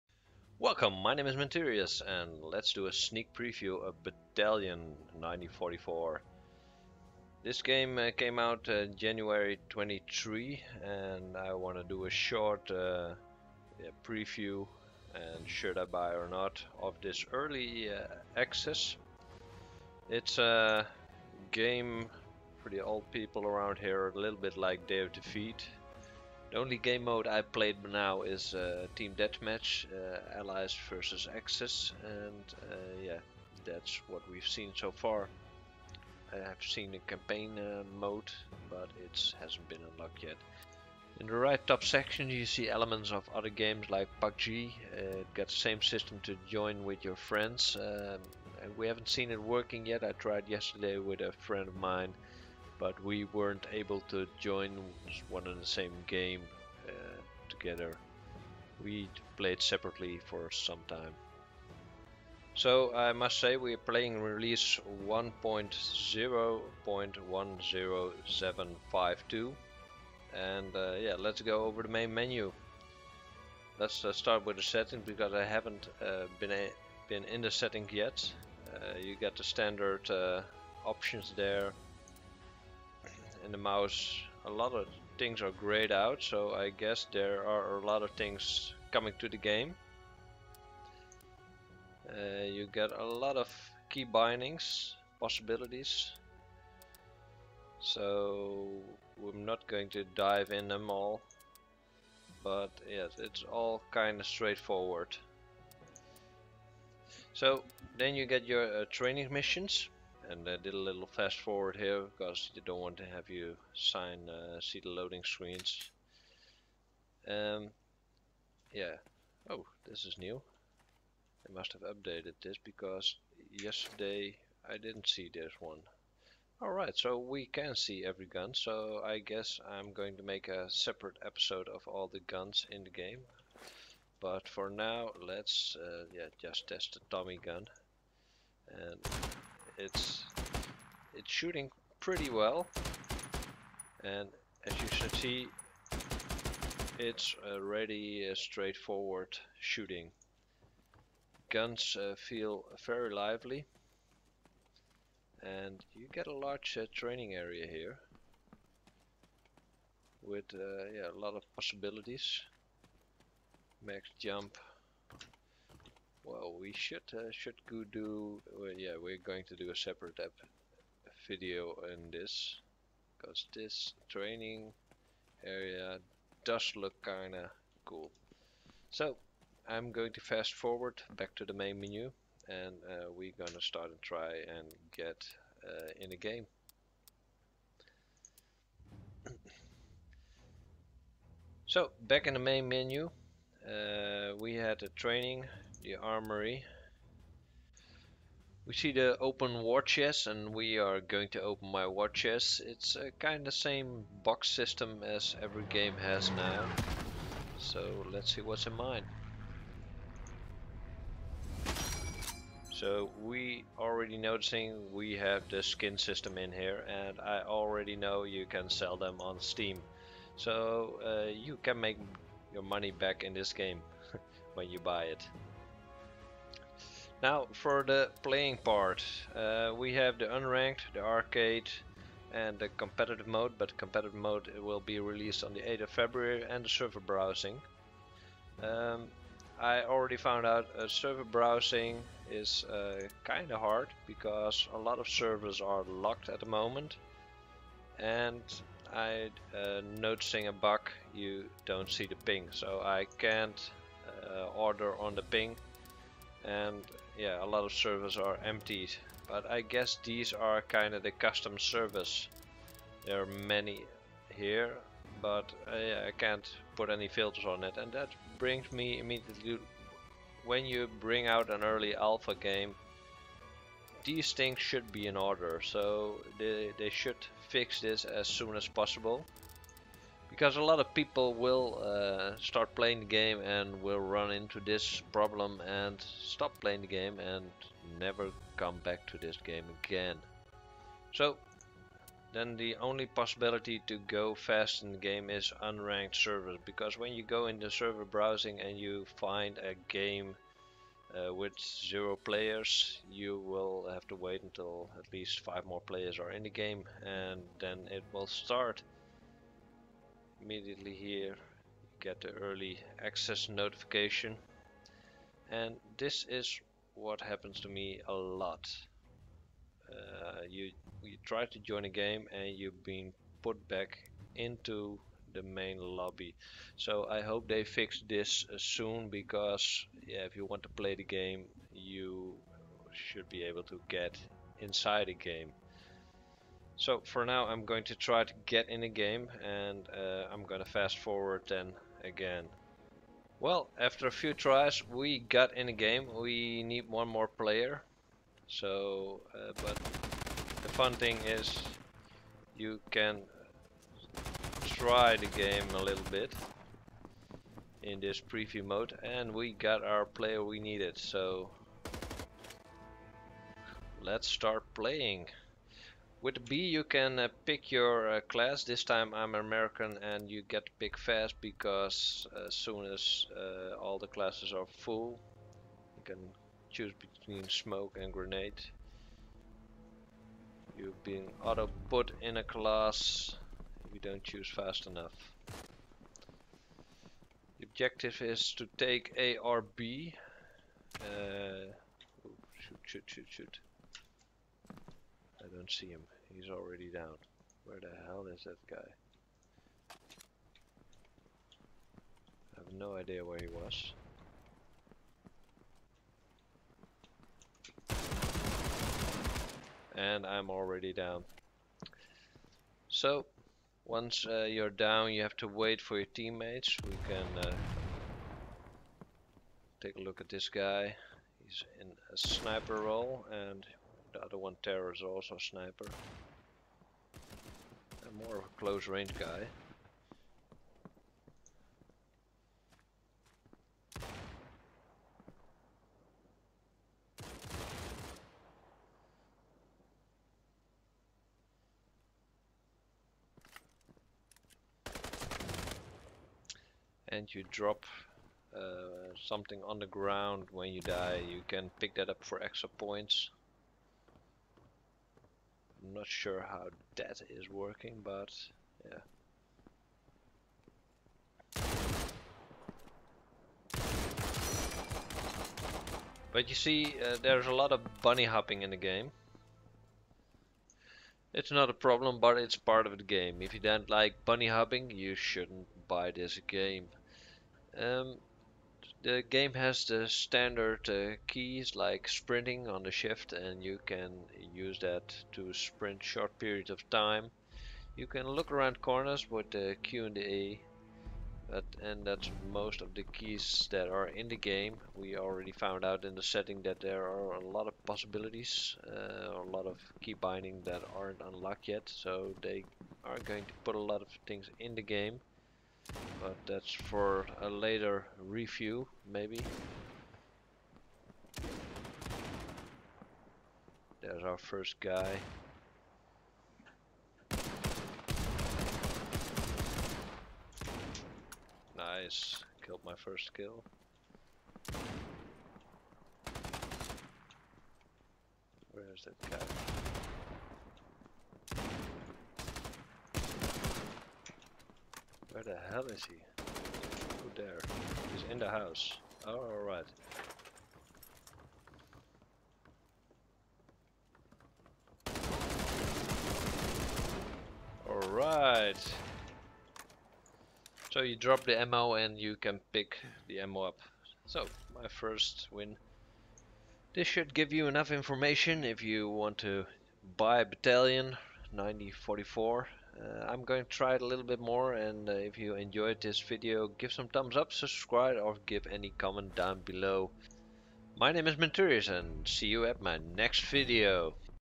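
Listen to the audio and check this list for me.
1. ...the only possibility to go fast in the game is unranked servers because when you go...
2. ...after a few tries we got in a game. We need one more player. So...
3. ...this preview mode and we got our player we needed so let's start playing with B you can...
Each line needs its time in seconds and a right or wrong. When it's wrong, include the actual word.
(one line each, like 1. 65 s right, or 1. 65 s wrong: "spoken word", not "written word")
1. 292 s right
2. 343 s right
3. 357 s right.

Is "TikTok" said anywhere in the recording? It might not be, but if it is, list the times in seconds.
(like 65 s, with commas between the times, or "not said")
not said.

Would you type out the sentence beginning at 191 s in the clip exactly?
so back in the main menu uh, we had a training the armory.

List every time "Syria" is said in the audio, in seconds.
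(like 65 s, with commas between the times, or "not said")
not said.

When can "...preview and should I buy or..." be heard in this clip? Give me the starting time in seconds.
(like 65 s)
14 s.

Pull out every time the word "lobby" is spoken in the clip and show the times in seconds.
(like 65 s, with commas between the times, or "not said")
325 s.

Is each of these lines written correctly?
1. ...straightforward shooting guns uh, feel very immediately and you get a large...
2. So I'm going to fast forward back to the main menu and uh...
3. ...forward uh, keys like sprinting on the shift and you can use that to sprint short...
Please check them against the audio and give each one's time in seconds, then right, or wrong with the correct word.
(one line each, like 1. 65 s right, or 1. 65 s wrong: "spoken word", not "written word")
1. 148 s wrong: "lively", not "immediately"
2. 178 s right
3. 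480 s wrong: "standard", not "forward".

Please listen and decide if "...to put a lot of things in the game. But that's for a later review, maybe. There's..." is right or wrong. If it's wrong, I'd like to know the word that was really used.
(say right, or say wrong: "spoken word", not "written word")
right.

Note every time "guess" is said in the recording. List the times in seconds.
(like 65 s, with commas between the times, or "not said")
86 s, 129 s, 259 s.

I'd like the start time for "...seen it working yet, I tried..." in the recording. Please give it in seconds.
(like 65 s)
49 s.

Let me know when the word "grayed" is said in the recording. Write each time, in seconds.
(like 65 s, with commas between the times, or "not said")
85 s.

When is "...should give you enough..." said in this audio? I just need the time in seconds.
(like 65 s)
557 s.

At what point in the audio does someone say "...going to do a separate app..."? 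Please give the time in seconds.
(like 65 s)
169 s.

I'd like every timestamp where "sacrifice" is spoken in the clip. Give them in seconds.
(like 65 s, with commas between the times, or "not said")
not said.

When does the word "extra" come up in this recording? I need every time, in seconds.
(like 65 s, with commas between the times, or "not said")
452 s.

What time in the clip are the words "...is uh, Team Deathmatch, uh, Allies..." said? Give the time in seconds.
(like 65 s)
28 s.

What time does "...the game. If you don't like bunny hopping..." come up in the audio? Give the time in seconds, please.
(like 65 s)
472 s.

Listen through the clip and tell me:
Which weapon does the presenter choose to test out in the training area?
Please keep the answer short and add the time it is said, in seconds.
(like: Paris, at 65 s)
Tommy gun, at 137 s.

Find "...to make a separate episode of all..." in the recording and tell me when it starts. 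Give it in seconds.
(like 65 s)
130 s.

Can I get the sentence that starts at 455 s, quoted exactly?
I'm not sure how that is working, but yeah.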